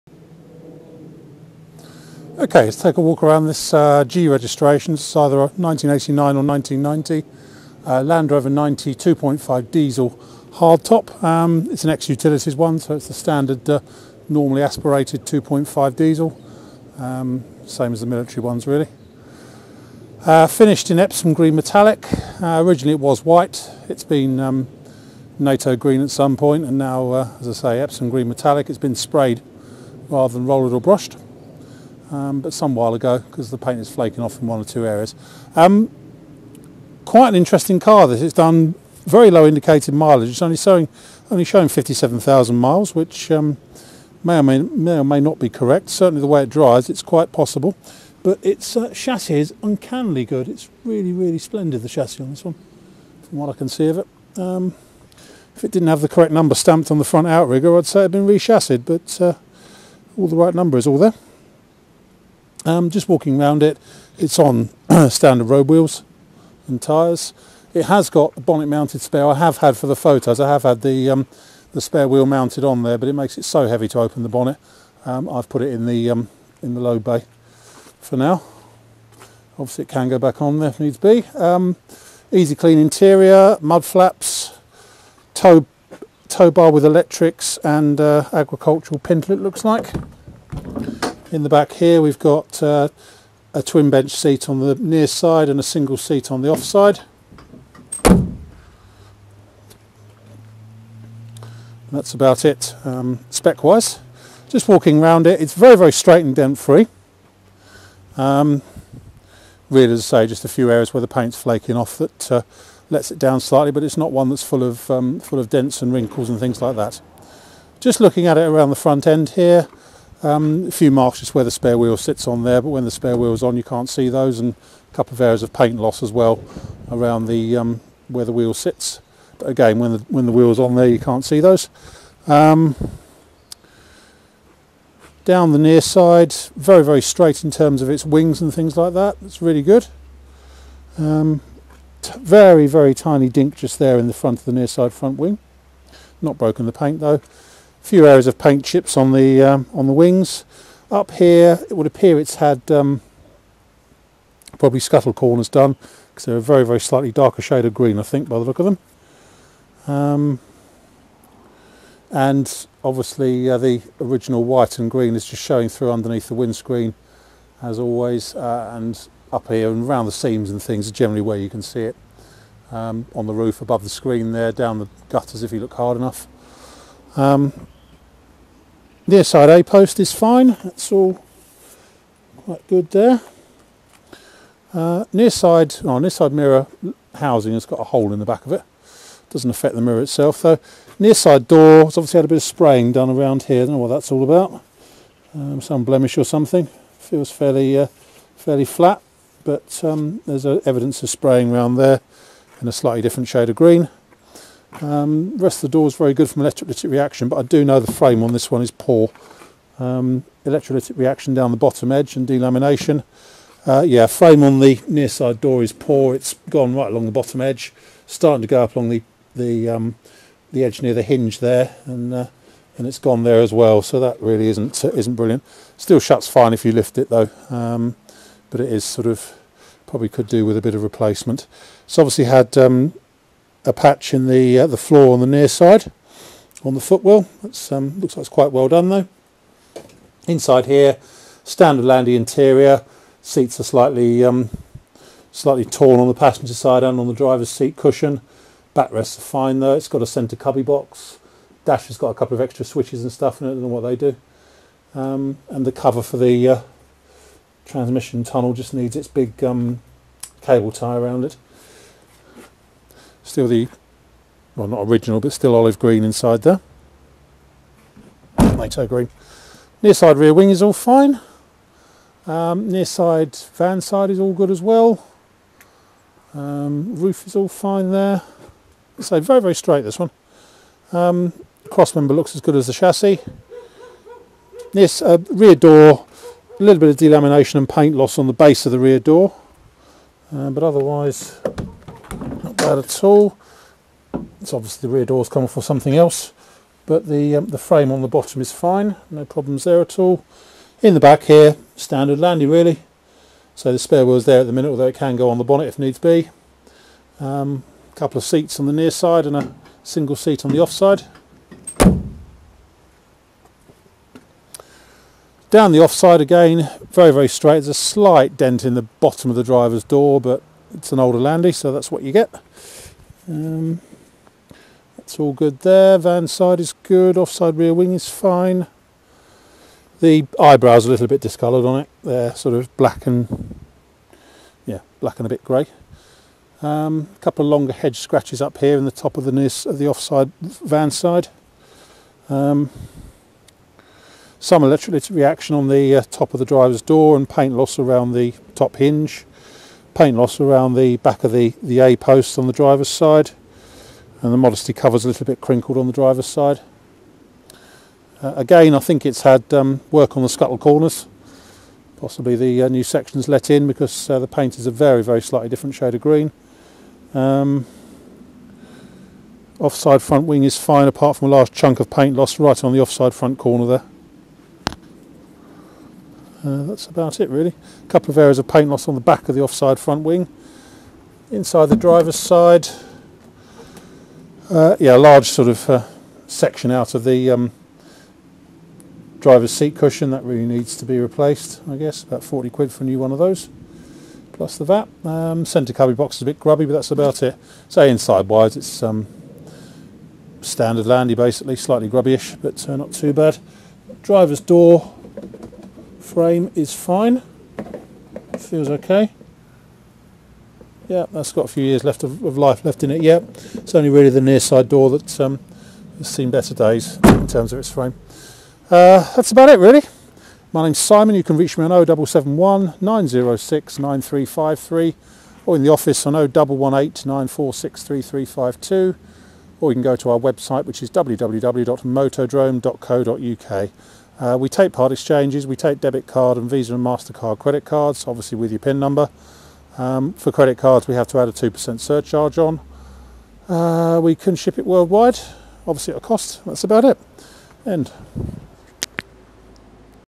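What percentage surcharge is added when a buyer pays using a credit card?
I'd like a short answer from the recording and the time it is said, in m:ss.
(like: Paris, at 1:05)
2%, at 7:21.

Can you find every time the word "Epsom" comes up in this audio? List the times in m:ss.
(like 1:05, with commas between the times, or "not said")
0:20, 0:27.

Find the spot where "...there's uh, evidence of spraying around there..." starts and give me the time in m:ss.
3:20.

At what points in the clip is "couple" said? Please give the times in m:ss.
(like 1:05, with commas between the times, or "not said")
2:04, 4:12, 5:07, 5:37, 6:17.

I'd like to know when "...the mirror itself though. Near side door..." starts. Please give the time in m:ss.
3:09.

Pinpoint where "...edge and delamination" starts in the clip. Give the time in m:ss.
3:31.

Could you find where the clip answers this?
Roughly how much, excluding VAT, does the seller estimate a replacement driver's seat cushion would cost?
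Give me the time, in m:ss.
6:32.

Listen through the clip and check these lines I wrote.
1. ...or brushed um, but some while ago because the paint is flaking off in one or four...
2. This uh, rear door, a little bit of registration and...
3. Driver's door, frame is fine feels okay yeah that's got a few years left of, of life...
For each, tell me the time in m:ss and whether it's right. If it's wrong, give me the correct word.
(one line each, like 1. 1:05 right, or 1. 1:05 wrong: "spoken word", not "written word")
1. 0:30 wrong: "two", not "four"
2. 4:44 wrong: "delamination", not "registration"
3. 6:44 right.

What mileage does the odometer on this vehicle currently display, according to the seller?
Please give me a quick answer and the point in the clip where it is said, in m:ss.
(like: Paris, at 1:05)
57,000 miles, at 0:41.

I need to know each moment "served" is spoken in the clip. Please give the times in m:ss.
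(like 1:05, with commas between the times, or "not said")
not said.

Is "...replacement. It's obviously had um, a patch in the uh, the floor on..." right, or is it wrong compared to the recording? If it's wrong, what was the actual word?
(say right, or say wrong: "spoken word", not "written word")
right.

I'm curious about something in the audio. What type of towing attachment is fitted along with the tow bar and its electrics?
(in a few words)
Agricultural pintle.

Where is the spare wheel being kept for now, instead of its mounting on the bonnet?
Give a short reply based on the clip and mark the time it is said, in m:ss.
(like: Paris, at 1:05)
Load bay, at 1:16.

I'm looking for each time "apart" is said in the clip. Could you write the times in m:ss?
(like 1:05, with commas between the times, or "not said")
6:10.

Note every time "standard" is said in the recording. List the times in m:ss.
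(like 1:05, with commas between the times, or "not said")
0:13, 1:05, 4:01, 5:01, 6:40.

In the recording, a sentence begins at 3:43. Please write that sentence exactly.
So that really isn't isn't brilliant.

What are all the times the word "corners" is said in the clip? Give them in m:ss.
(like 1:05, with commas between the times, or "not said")
2:35, 6:00, 6:13.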